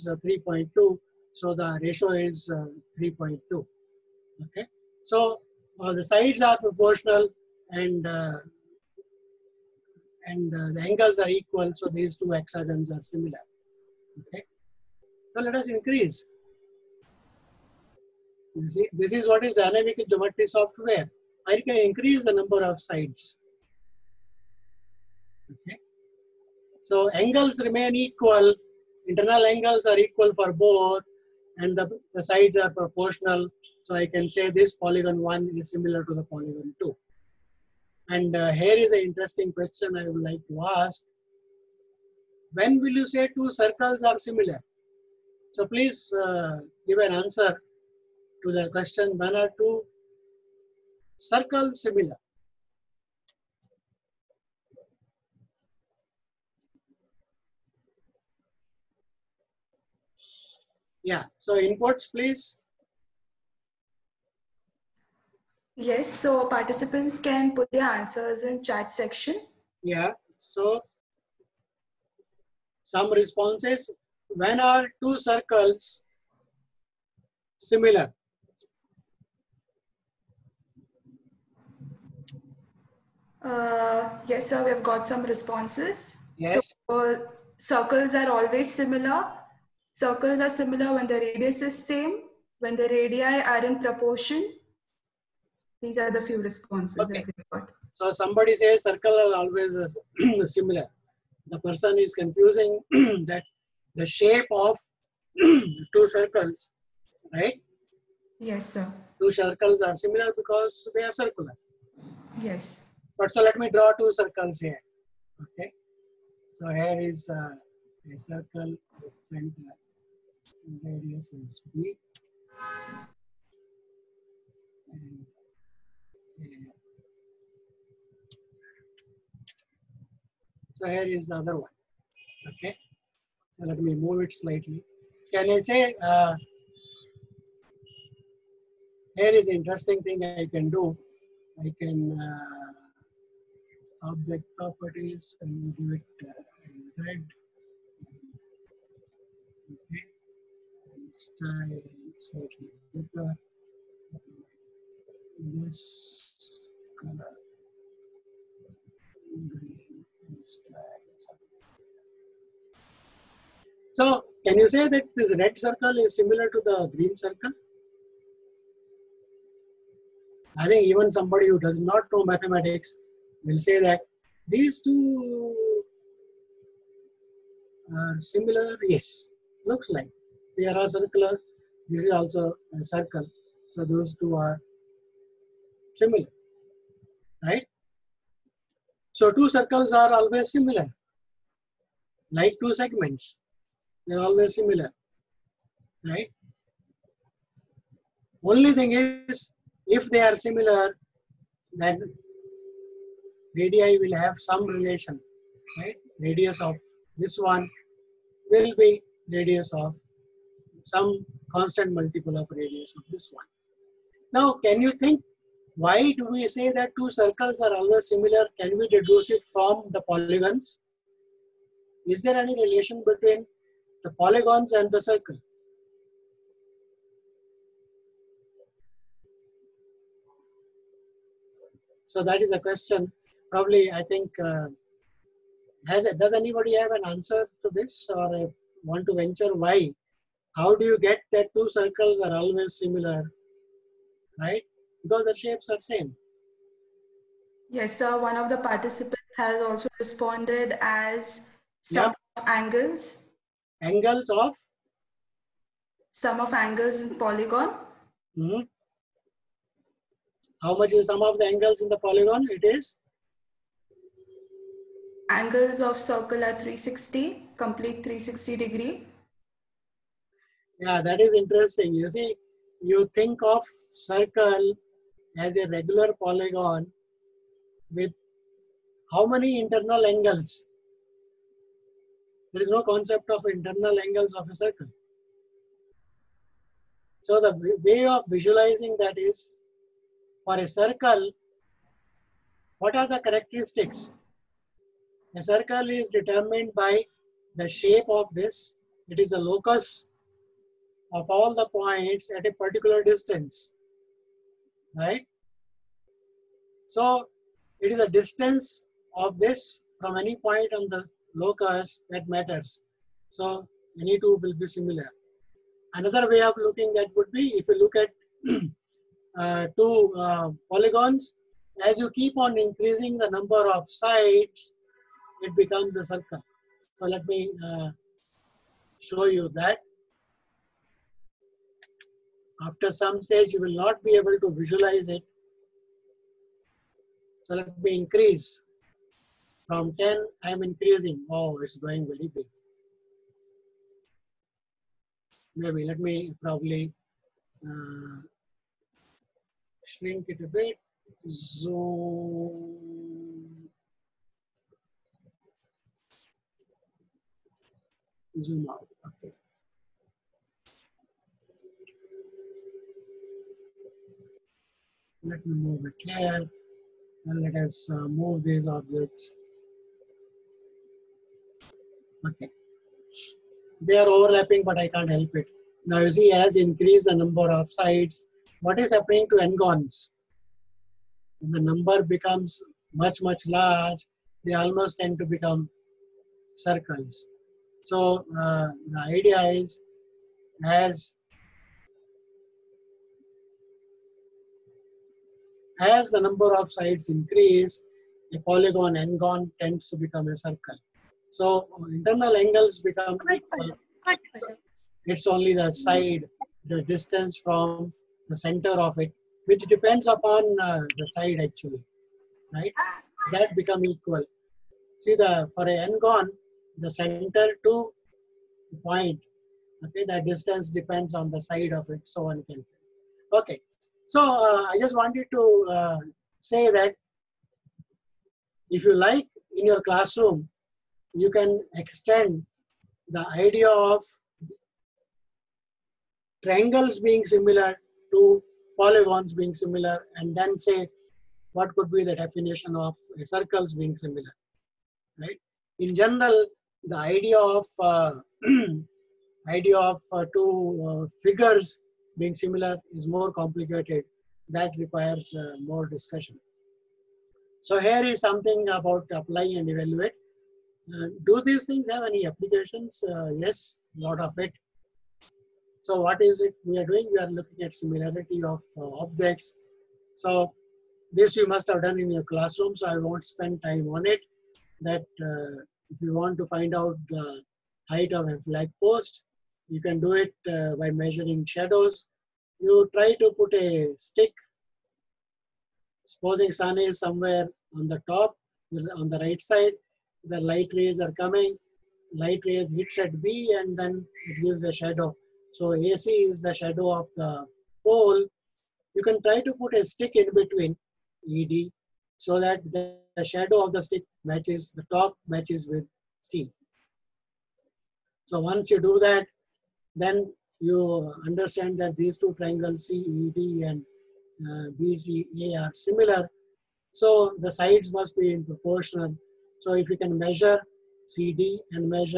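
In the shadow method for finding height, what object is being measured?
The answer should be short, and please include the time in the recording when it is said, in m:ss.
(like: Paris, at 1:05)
flag post, at 7:58.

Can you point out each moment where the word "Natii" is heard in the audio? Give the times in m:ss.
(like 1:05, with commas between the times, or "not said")
not said.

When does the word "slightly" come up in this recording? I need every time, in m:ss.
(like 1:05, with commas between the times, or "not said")
2:14, 2:32.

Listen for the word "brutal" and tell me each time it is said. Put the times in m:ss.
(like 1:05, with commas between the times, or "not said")
not said.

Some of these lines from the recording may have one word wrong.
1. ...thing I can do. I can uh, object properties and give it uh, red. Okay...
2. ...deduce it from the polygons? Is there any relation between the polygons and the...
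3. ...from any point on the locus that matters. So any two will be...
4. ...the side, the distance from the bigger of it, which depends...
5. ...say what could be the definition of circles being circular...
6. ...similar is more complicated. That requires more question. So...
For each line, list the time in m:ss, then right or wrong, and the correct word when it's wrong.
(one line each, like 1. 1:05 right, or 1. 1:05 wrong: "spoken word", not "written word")
1. 2:20 right
2. 3:38 right
3. 5:09 right
4. 6:45 wrong: "center", not "bigger"
5. 7:20 wrong: "similar", not "circular"
6. 7:32 wrong: "discussion", not "question".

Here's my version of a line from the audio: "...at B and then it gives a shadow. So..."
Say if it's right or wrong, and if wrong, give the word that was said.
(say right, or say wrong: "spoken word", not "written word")
right.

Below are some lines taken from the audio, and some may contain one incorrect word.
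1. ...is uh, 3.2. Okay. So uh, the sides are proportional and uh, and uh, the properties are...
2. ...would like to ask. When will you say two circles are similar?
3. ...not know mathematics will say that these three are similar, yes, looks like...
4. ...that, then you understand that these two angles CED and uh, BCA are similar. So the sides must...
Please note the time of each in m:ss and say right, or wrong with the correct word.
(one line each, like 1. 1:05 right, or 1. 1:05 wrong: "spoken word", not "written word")
1. 0:02 wrong: "angles", not "properties"
2. 0:40 right
3. 2:51 wrong: "two", not "three"
4. 8:29 wrong: "triangles", not "angles".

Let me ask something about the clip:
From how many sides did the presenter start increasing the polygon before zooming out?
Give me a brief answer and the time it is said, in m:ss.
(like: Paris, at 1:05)
10, at 5:39.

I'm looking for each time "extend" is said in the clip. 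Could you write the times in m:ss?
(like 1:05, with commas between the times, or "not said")
7:11.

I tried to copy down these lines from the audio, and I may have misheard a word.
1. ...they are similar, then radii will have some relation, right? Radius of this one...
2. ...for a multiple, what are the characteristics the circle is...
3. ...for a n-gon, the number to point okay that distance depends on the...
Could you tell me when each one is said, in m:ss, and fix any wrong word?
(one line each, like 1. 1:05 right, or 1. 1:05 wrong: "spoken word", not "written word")
1. 3:20 right
2. 4:50 wrong: "circle", not "multiple"
3. 6:55 wrong: "center", not "number".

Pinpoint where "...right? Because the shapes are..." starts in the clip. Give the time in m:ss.
4:04.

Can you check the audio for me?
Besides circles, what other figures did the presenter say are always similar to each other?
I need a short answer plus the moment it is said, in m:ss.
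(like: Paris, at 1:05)
segments, at 3:12.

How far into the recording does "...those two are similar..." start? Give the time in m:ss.
3:03.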